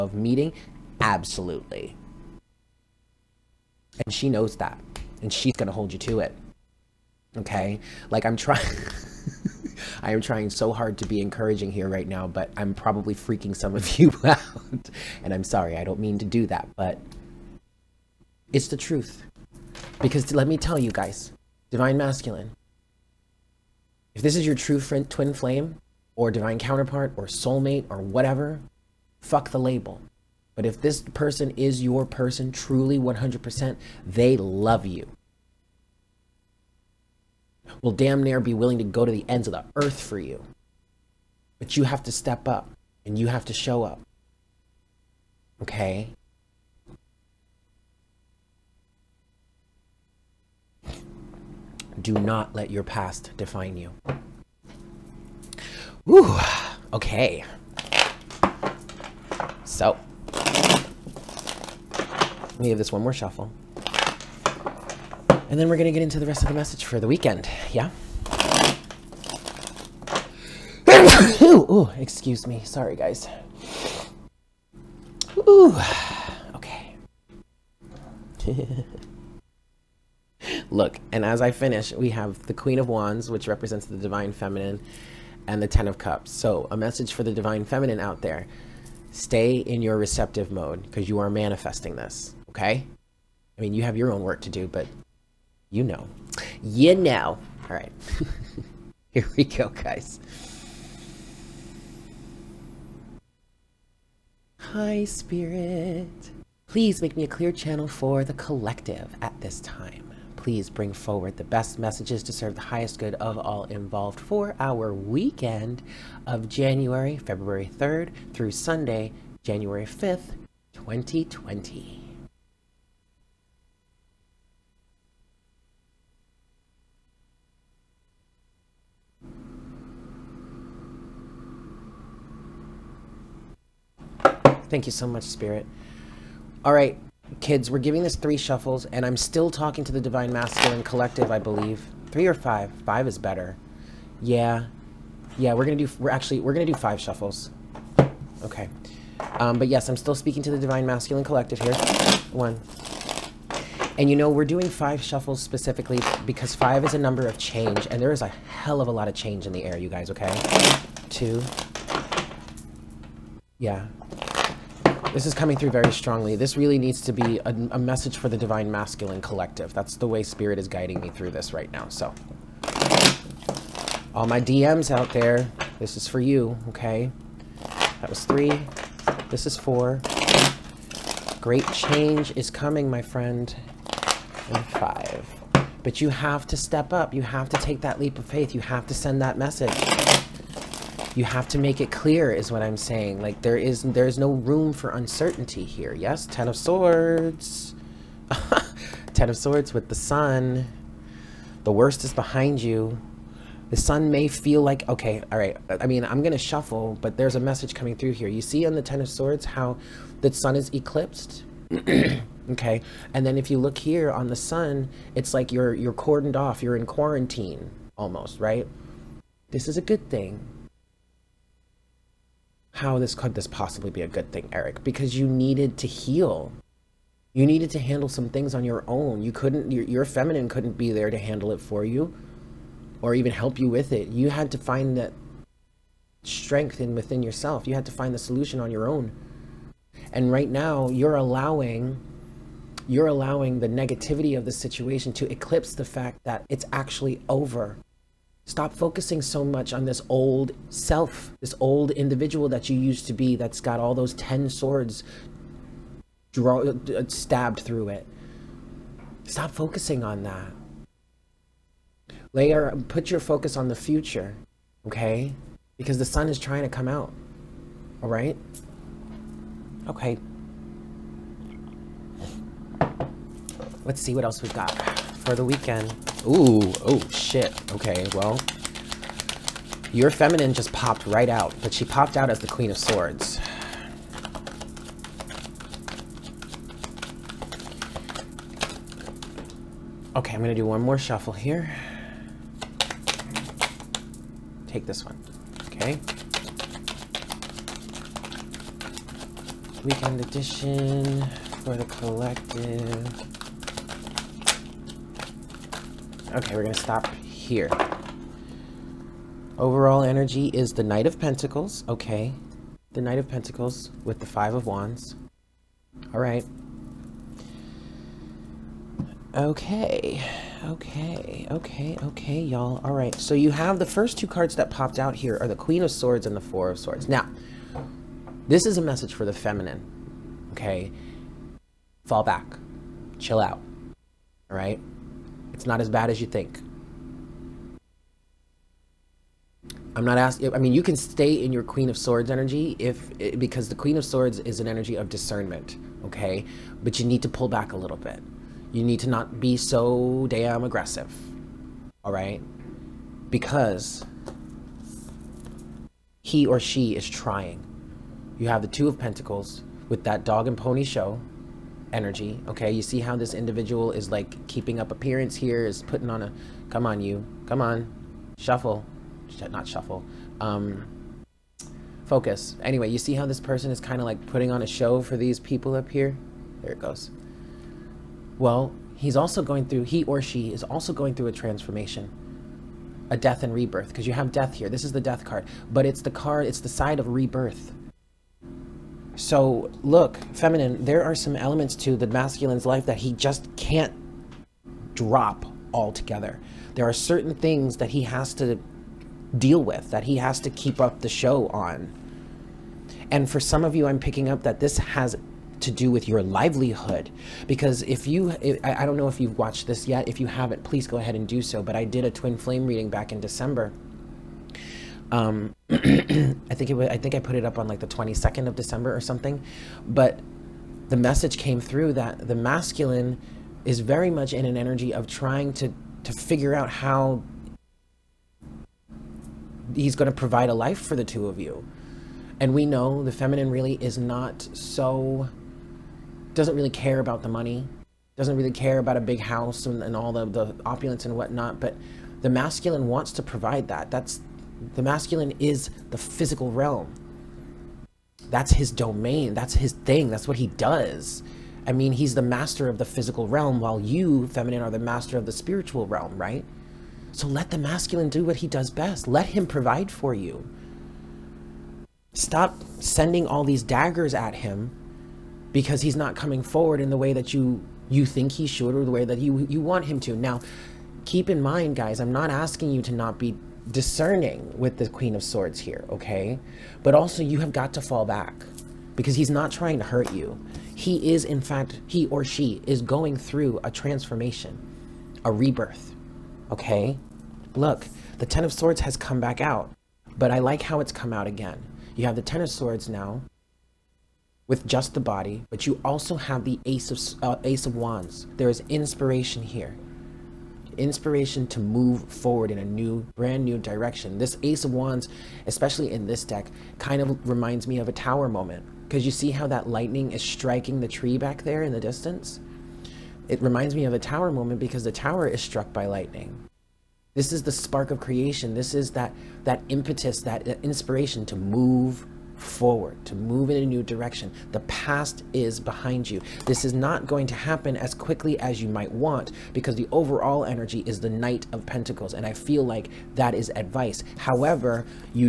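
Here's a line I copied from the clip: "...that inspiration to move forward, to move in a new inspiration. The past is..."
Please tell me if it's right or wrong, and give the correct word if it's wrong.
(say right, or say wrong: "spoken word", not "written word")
wrong: "direction", not "inspiration".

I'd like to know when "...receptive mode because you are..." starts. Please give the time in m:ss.
1:29.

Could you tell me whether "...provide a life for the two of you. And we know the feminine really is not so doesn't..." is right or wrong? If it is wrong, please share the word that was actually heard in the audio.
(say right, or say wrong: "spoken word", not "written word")
right.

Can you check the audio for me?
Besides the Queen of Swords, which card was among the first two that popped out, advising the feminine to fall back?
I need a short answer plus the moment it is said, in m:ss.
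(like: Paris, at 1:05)
Four of Swords, at 5:26.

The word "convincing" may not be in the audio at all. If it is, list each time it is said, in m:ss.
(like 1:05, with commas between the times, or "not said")
not said.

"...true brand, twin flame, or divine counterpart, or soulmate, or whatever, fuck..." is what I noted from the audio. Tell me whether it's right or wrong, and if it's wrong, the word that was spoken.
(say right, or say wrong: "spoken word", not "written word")
wrong: "friend", not "brand".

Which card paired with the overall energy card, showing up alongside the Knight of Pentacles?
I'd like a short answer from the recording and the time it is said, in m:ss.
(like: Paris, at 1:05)
Five of Wands, at 5:14.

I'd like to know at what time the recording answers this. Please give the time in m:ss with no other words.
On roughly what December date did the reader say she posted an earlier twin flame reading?
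6:57.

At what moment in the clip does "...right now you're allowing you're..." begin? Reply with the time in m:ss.
4:00.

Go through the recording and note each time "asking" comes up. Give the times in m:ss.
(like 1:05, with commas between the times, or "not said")
5:40, 7:52.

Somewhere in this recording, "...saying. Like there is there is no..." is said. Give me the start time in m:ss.
3:12.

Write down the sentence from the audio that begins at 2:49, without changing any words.
That's the way Spirit is guiding me through this right now, so.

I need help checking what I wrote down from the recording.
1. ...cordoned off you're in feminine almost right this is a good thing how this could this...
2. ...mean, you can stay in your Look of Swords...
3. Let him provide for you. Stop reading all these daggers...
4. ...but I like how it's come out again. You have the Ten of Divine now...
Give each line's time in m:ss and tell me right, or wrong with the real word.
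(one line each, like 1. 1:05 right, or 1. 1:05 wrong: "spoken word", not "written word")
1. 3:35 wrong: "quarantine", not "feminine"
2. 5:40 wrong: "Queen", not "Look"
3. 7:39 wrong: "sending", not "reading"
4. 8:10 wrong: "Swords", not "Divine".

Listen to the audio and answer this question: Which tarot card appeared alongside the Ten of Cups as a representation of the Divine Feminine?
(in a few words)
Queen of Wands.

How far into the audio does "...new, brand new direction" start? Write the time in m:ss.
8:22.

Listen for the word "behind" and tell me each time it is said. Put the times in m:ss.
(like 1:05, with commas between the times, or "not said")
3:22, 8:45.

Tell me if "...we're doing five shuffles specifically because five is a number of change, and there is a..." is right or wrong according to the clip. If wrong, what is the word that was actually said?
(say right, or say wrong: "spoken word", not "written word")
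right.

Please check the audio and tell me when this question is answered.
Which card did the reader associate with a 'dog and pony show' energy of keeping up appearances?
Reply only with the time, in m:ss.
5:58.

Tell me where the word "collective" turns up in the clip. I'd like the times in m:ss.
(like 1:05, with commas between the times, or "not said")
1:48, 2:20, 2:31, 2:49, 5:01.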